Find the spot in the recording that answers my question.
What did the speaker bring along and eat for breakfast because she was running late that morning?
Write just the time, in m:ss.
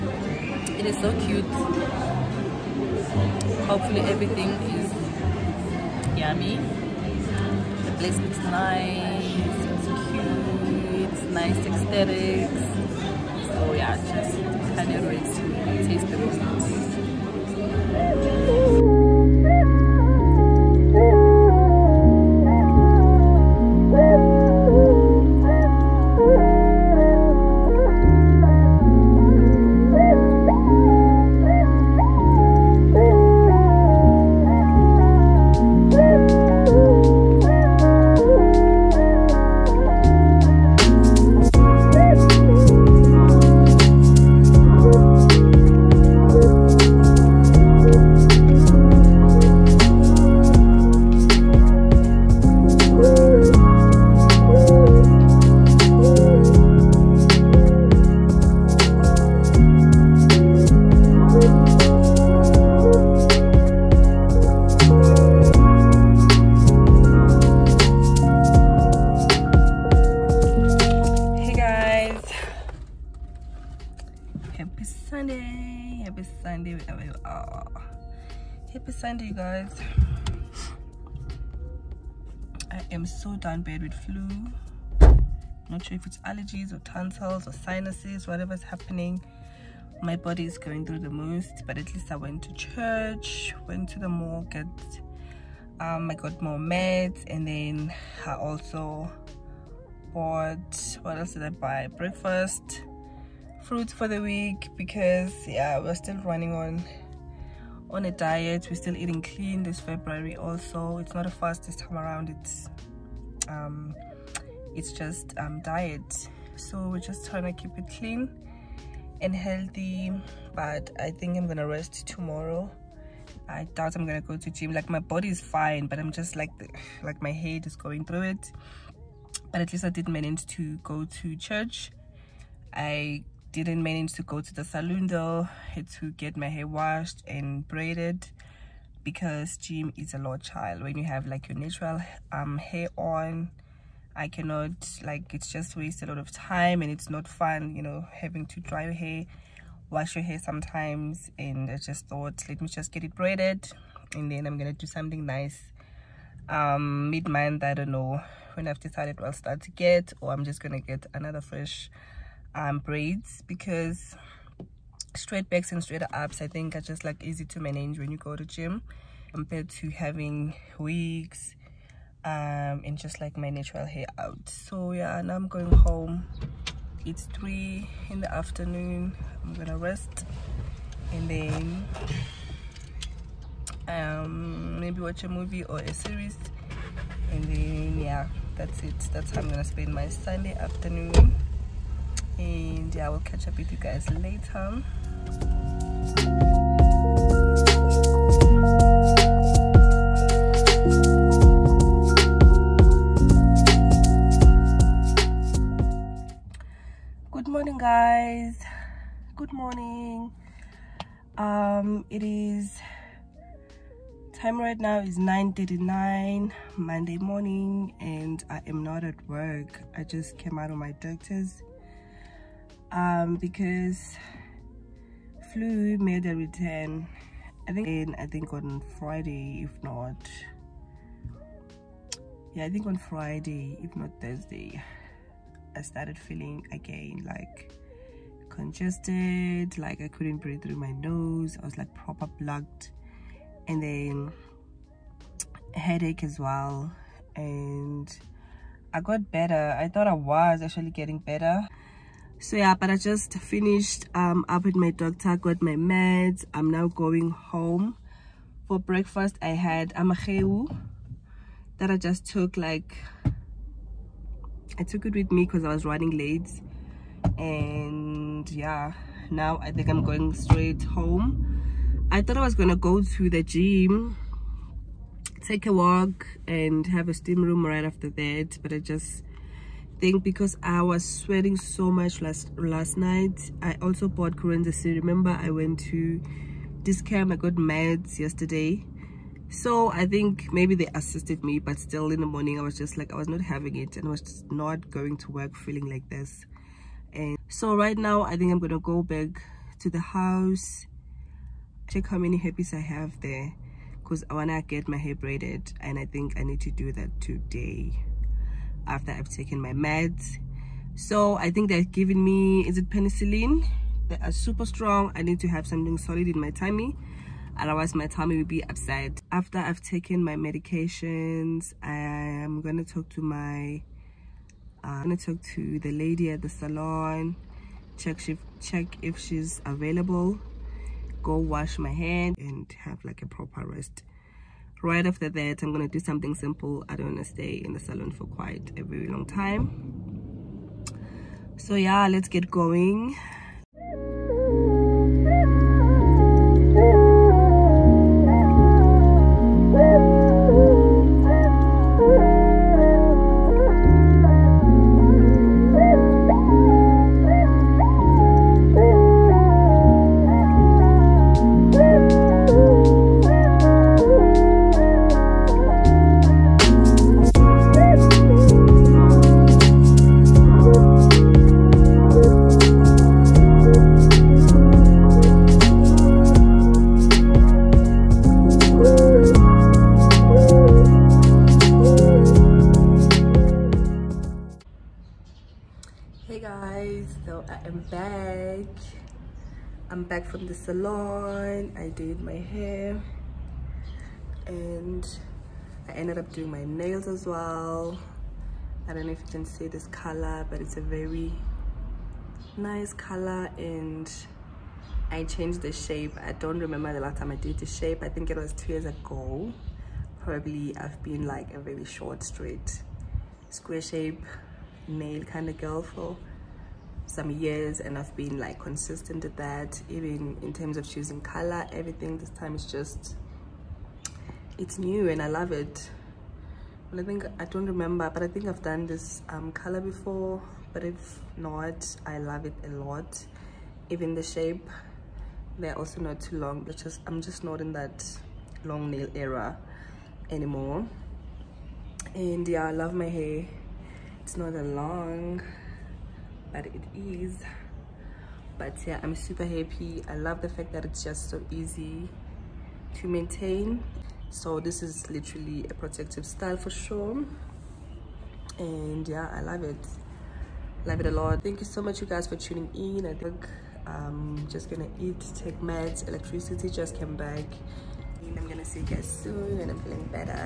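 4:19.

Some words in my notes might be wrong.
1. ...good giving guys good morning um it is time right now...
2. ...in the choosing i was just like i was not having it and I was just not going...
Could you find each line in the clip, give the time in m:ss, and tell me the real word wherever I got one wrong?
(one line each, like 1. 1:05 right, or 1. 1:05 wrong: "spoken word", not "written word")
1. 3:27 wrong: "morning", not "giving"
2. 4:52 wrong: "morning", not "choosing".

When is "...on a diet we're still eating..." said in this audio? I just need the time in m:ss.
1:47.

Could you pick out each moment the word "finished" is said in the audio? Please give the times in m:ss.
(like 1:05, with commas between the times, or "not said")
4:13.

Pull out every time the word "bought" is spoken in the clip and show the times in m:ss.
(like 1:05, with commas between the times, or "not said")
1:40, 4:44.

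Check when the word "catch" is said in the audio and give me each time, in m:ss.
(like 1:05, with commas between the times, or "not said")
3:13.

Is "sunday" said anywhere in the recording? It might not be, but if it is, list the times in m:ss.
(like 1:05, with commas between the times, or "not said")
1:19, 3:10.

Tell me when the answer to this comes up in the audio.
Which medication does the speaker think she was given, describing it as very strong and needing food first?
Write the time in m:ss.
5:12.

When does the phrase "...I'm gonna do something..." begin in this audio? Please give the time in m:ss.
2:34.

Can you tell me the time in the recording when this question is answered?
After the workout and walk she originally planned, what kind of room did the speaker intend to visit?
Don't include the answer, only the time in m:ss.
4:37.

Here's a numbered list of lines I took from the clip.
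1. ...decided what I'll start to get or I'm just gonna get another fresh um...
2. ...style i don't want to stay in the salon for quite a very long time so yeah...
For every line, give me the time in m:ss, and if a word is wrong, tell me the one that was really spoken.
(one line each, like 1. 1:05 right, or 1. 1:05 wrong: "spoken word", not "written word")
1. 2:38 right
2. 5:36 wrong: "simple", not "style".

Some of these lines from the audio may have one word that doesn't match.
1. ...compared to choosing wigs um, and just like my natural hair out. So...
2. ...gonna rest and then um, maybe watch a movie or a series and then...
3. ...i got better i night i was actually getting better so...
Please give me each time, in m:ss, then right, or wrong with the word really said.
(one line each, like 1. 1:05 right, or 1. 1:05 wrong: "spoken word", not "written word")
1. 2:49 wrong: "having", not "choosing"
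2. 2:59 right
3. 4:08 wrong: "thought", not "night".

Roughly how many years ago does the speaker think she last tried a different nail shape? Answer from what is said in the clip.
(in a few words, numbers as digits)
2.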